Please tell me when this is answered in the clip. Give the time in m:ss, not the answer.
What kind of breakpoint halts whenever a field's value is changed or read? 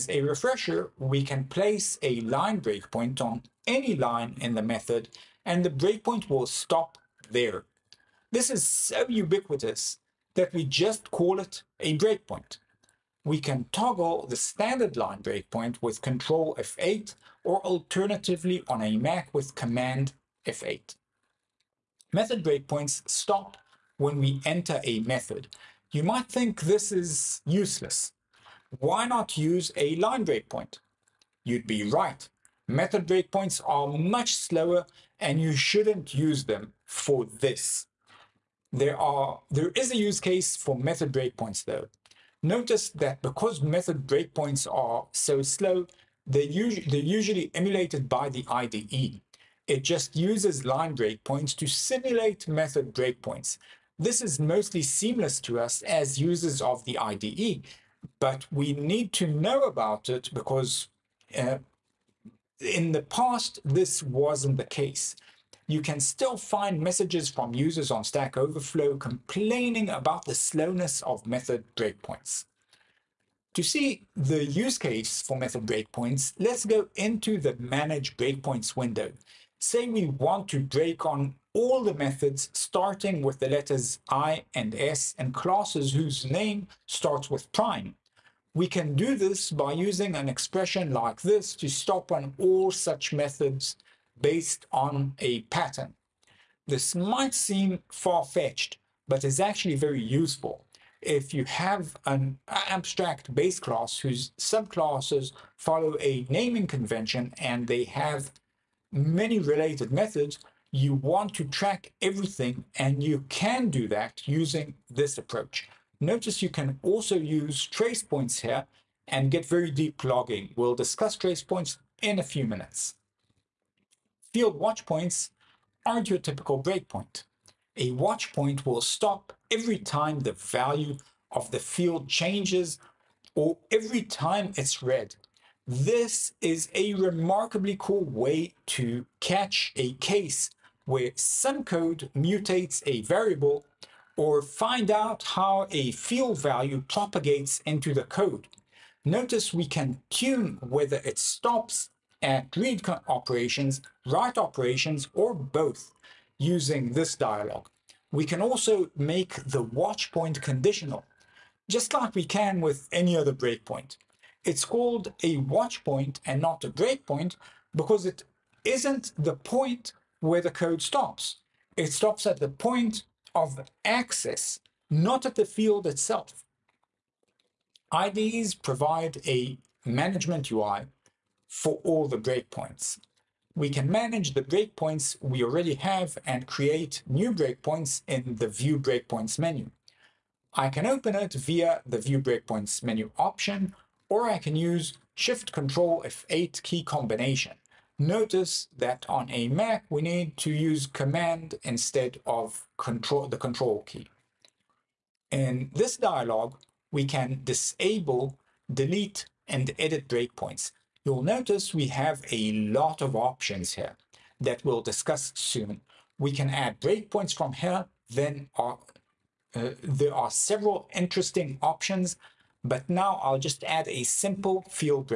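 2:04.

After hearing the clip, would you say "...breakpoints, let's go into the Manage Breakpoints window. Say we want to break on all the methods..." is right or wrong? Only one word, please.
right.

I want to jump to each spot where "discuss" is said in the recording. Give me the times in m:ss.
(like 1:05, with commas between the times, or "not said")
2:00, 3:34.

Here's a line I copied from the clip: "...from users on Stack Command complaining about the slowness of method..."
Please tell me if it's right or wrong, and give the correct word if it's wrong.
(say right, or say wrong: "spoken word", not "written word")
wrong: "Overflow", not "Command".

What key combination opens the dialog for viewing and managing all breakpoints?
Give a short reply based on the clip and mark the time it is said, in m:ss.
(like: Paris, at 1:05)
Shift Control F8, at 3:15.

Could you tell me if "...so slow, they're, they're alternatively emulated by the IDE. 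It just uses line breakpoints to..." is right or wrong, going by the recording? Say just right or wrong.
wrong.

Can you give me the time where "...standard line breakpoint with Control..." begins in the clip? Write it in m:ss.
0:14.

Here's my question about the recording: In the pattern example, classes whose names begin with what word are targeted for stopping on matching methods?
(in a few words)
prime.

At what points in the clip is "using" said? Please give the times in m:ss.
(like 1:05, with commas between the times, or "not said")
1:29, 1:54, 2:36.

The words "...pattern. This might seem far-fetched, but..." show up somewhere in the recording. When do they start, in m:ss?
1:35.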